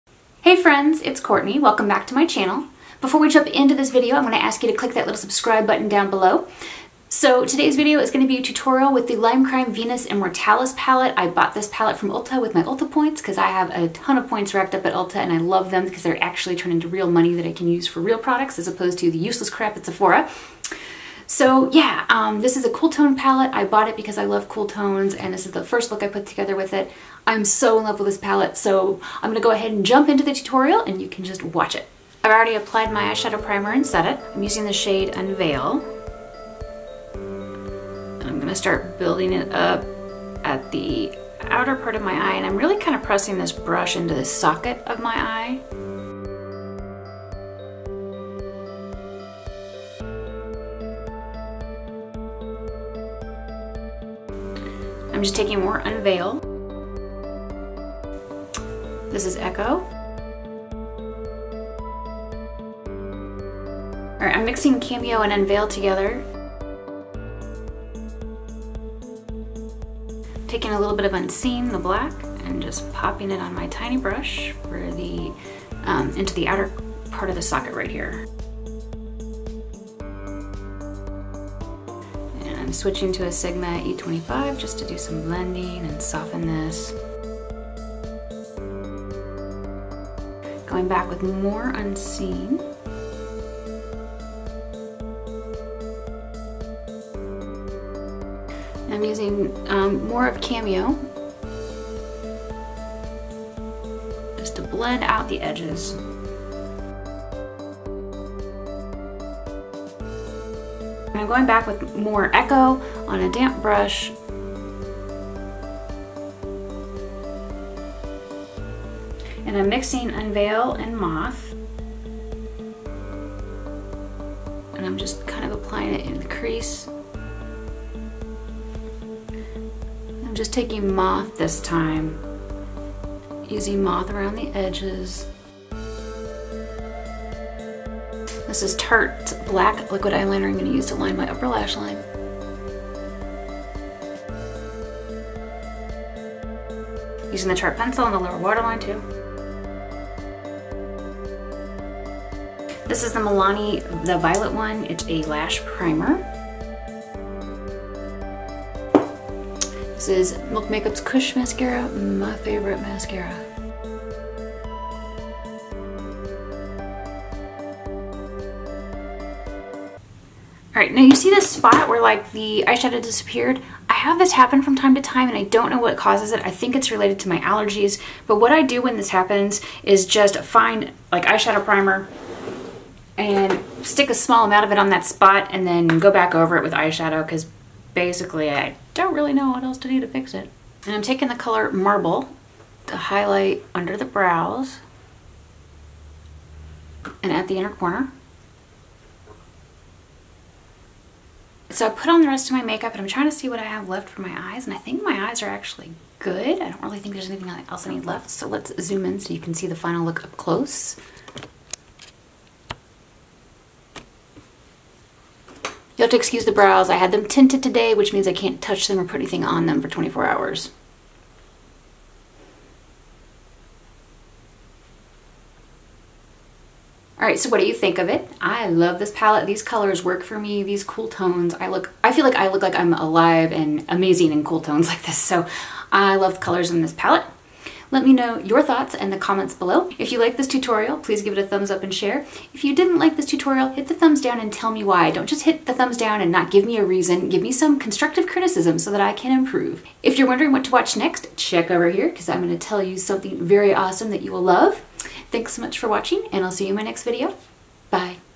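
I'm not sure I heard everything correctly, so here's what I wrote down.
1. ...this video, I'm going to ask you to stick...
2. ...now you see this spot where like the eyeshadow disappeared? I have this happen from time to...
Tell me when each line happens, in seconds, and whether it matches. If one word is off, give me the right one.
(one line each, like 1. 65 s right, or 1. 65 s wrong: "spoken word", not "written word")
1. 3 s wrong: "click", not "stick"
2. 170 s right.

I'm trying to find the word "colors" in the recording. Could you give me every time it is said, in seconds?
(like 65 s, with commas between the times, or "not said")
191 s, 229 s, 236 s.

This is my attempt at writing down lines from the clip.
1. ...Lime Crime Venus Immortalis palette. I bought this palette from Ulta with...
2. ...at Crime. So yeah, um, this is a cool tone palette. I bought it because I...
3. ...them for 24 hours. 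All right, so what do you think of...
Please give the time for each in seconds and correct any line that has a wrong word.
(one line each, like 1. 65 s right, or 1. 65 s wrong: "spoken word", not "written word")
1. 9 s right
2. 19 s wrong: "Sephora", not "Crime"
3. 219 s right.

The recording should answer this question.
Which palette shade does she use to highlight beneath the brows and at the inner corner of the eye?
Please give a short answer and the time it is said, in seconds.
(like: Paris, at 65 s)
Marble, at 191 s.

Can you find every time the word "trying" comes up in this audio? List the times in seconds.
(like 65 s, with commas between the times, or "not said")
203 s.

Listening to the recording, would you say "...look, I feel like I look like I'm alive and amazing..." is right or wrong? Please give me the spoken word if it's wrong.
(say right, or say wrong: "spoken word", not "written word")
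right.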